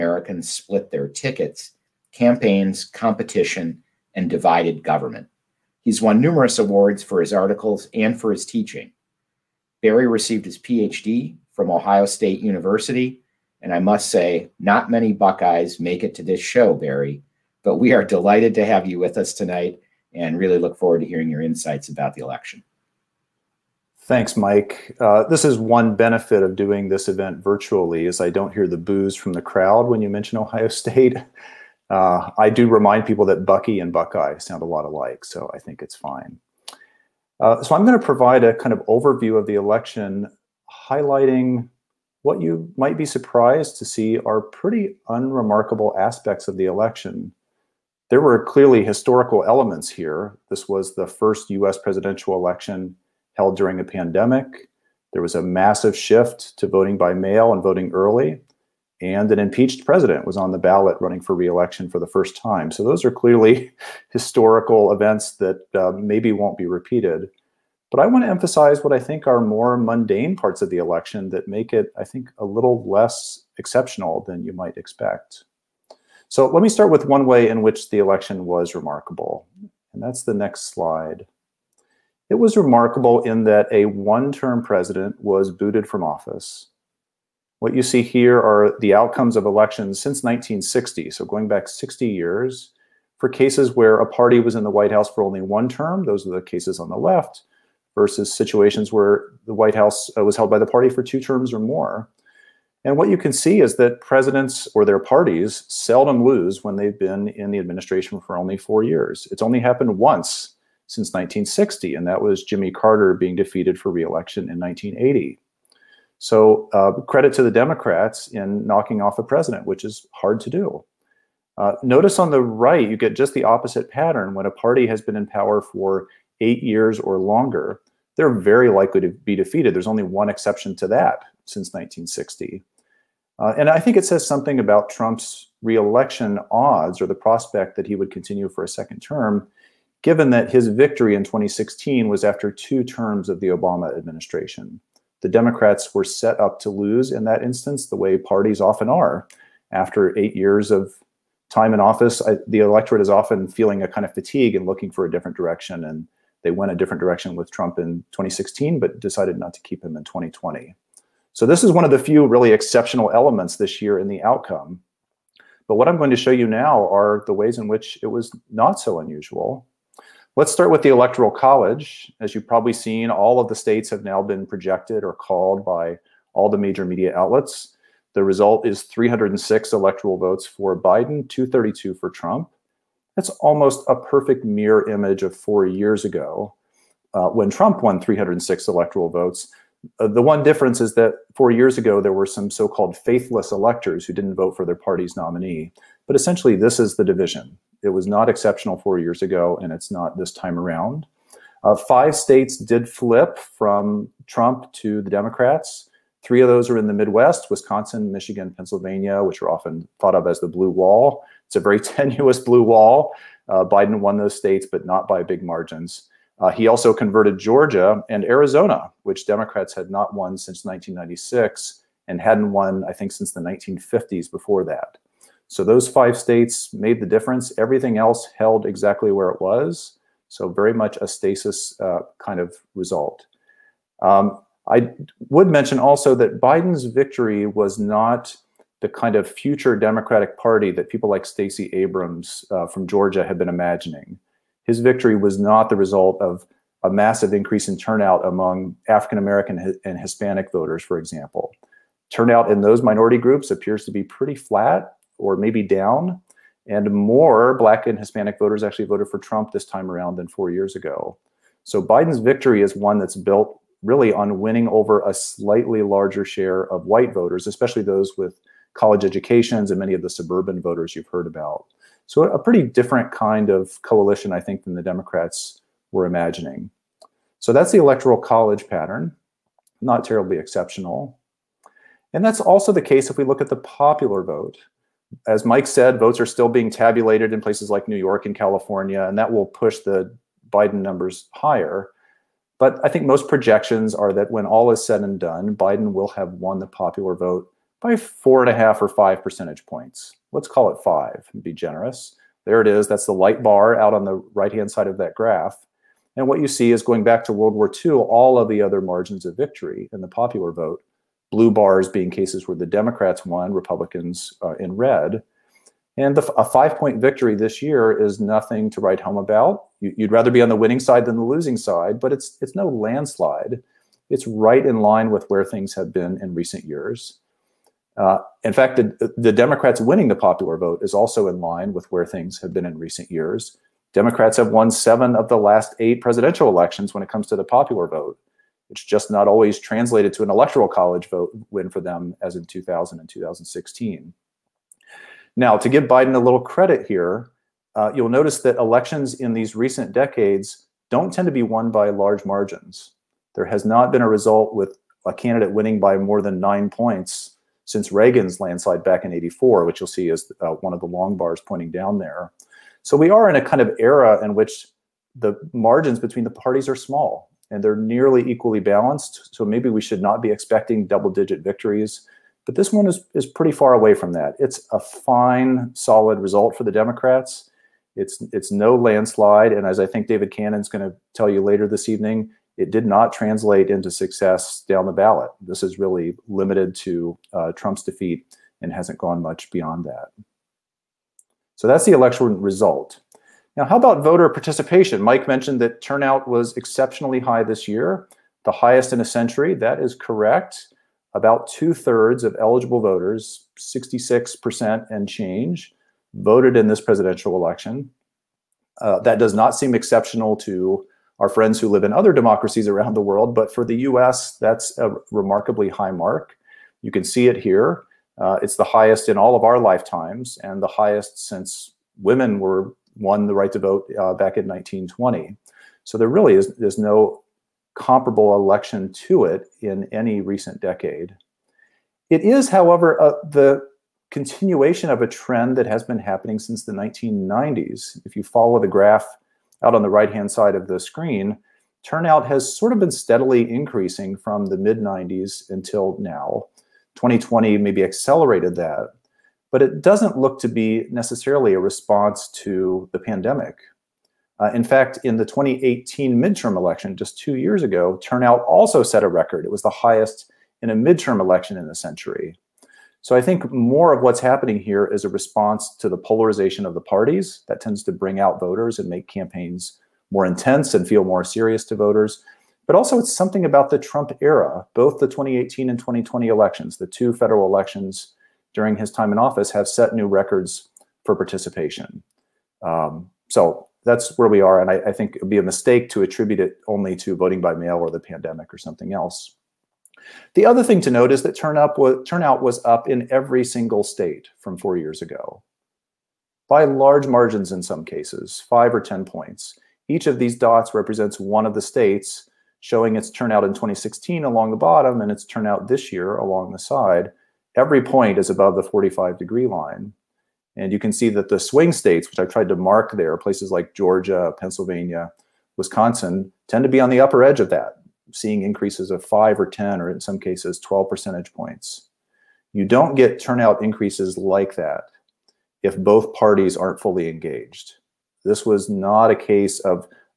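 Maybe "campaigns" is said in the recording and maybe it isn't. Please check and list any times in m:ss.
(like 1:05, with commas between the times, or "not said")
0:02, 7:49.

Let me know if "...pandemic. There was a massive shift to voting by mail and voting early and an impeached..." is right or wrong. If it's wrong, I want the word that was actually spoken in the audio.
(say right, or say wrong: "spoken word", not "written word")
right.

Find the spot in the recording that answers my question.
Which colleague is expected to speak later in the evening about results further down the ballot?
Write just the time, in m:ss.
6:20.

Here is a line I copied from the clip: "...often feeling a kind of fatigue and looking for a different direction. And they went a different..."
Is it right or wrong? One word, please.
right.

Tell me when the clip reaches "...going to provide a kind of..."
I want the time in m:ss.
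0:37.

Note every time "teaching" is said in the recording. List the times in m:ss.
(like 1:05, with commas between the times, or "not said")
0:08.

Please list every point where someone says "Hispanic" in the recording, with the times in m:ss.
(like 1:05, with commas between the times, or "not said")
4:09, 4:17.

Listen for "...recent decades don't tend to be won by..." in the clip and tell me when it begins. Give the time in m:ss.
5:49.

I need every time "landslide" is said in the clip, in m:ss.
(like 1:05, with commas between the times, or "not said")
5:22, 5:58, 6:18.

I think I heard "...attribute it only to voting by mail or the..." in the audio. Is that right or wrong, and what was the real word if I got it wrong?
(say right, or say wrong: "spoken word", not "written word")
right.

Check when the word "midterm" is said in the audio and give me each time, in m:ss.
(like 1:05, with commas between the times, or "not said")
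7:36, 7:40.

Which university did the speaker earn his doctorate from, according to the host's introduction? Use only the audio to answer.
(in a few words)
Ohio State University.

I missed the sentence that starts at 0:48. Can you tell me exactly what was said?
There were clearly historical elements here.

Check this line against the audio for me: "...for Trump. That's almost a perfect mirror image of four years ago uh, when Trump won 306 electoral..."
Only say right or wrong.
right.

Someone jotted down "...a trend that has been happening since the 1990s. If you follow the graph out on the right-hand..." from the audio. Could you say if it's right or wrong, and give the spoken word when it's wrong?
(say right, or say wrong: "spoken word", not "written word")
right.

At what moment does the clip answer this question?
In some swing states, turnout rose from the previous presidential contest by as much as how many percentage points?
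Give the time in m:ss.
8:40.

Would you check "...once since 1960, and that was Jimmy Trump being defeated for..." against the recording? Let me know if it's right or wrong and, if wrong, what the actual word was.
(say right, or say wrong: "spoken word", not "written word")
wrong: "Carter", not "Trump".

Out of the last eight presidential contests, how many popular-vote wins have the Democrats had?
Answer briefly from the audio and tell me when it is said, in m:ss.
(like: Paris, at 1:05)
7, at 5:34.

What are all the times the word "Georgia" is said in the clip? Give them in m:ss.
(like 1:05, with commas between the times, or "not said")
3:37, 4:02, 8:33.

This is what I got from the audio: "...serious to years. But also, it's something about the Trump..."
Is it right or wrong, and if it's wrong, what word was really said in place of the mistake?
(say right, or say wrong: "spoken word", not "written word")
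wrong: "voters", not "years".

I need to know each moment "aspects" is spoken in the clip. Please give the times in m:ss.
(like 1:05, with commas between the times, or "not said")
0:45.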